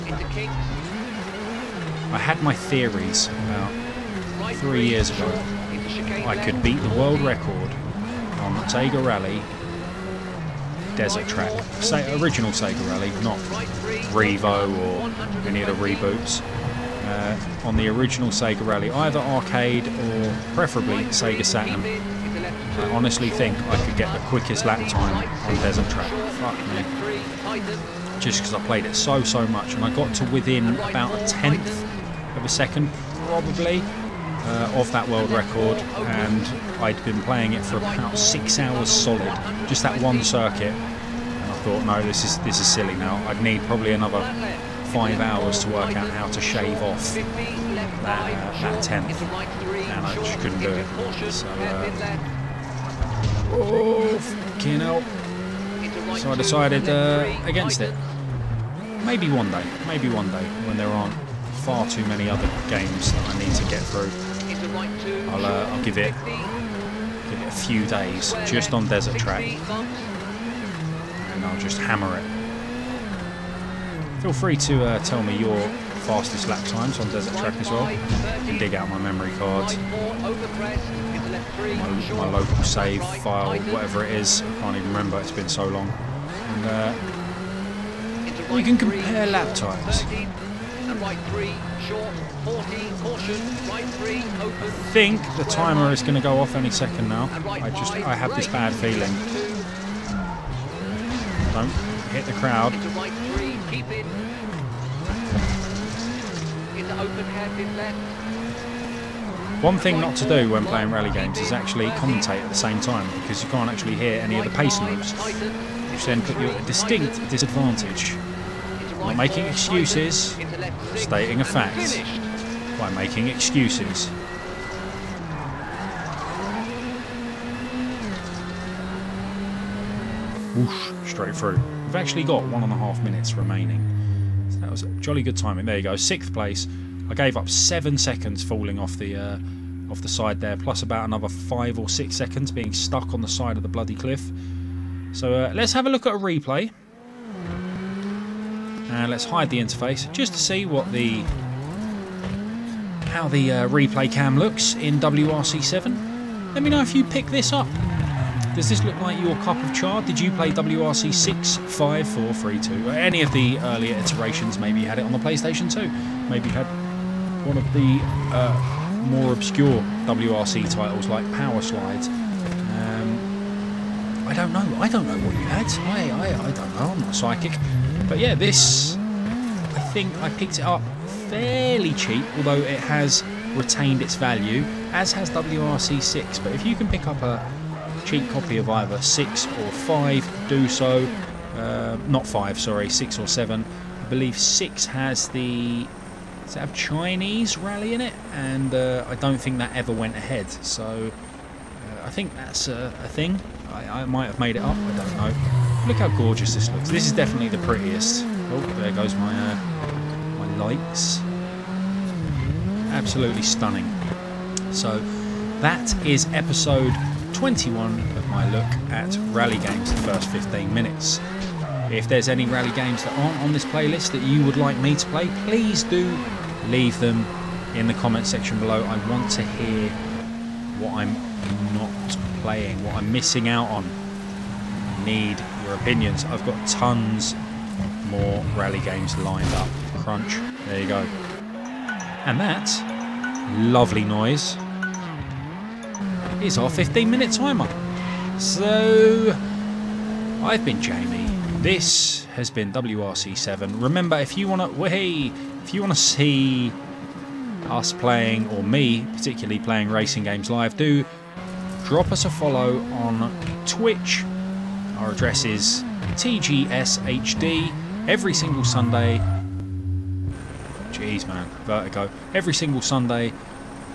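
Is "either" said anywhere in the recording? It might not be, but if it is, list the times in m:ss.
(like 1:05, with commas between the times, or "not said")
0:18, 3:08.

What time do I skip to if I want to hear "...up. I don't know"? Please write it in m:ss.
3:24.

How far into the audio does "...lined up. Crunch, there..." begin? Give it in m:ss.
3:59.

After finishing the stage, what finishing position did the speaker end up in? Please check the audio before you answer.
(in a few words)
Sixth place.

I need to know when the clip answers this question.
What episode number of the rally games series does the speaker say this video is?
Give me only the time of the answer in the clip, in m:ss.
3:36.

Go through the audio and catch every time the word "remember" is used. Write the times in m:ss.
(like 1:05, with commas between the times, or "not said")
1:24, 4:13.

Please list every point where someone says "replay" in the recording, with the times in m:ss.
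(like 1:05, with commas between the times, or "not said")
2:26, 2:33.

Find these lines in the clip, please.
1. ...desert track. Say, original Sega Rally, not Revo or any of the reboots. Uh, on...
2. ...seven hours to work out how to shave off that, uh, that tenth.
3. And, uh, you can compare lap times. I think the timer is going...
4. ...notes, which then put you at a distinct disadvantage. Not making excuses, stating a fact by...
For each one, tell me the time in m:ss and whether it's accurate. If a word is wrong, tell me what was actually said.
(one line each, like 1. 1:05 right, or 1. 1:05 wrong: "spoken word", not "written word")
1. 0:10 right
2. 0:44 wrong: "five", not "seven"
3. 1:25 right
4. 1:54 right.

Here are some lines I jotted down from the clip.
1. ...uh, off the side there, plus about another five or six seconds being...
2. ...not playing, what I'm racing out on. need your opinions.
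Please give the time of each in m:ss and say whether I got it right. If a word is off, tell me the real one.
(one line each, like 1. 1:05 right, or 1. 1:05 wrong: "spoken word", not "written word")
1. 2:19 right
2. 3:51 wrong: "missing", not "racing".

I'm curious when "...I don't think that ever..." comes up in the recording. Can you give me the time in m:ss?
3:19.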